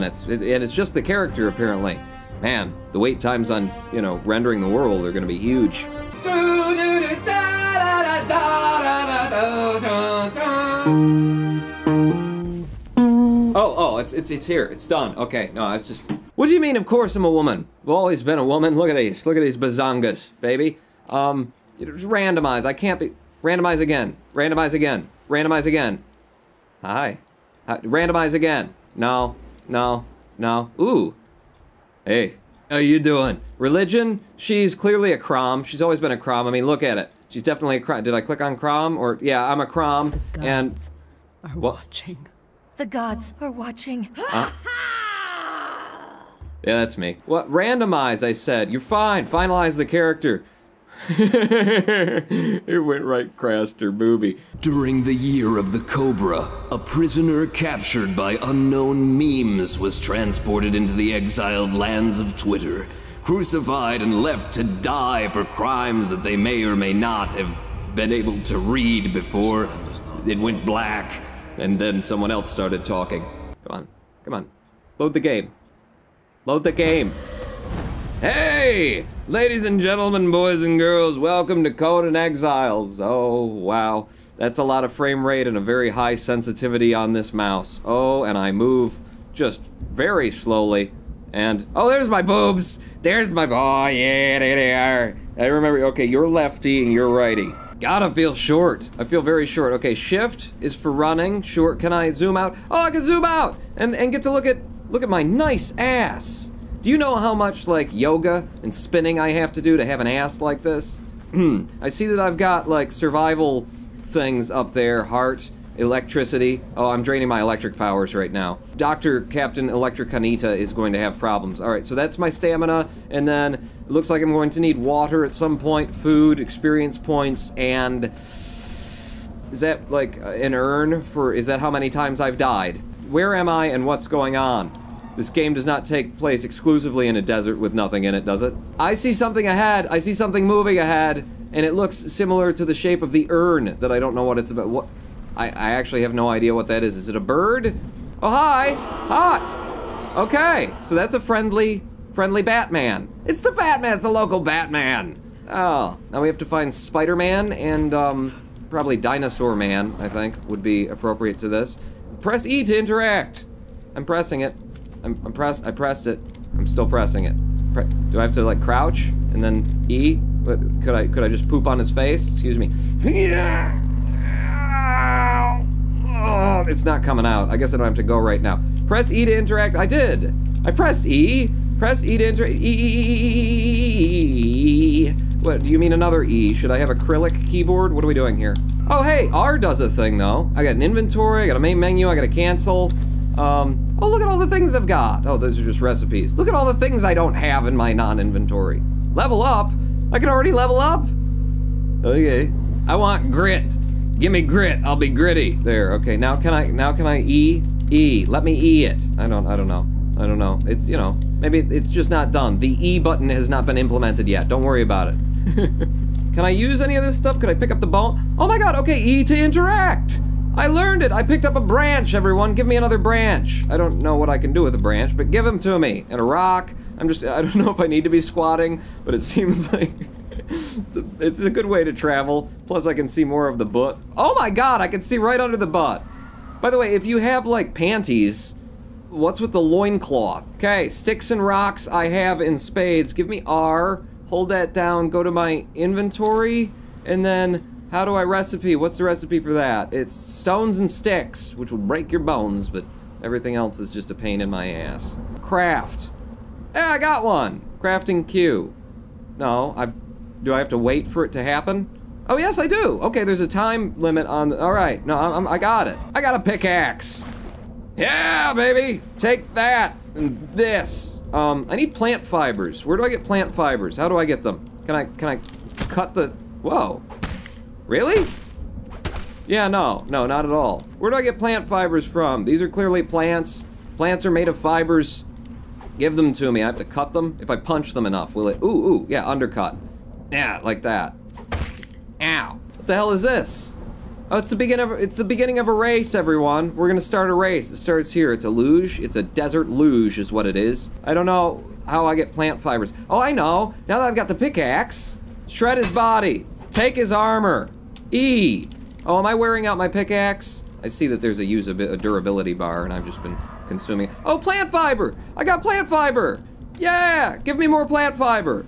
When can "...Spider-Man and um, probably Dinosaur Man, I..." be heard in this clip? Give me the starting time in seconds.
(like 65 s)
156 s.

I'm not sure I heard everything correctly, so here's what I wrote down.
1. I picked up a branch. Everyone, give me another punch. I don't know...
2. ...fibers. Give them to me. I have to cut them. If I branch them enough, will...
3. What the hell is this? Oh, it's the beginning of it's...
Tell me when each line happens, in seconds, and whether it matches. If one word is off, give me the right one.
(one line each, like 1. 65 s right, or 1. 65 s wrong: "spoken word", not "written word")
1. 221 s wrong: "branch", not "punch"
2. 284 s wrong: "punch", not "branch"
3. 292 s right.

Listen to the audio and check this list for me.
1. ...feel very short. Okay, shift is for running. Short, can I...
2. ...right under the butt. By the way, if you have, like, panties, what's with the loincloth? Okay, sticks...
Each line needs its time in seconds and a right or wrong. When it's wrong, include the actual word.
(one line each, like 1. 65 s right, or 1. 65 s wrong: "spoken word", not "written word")
1. 99 s right
2. 235 s right.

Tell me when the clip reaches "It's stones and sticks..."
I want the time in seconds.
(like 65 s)
249 s.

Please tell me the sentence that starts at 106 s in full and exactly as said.
Do you know how much, like, yoga and spinning I have to do to have an ass like this?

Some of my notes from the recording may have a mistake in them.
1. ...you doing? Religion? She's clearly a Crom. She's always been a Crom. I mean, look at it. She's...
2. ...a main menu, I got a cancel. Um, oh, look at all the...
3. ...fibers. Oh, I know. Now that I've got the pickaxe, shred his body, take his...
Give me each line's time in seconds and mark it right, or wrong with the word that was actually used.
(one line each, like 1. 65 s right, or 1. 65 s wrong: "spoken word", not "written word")
1. 32 s right
2. 191 s right
3. 302 s right.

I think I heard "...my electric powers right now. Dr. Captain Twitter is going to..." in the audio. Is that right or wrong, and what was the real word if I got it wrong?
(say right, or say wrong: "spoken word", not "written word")
wrong: "Electricanita", not "Twitter".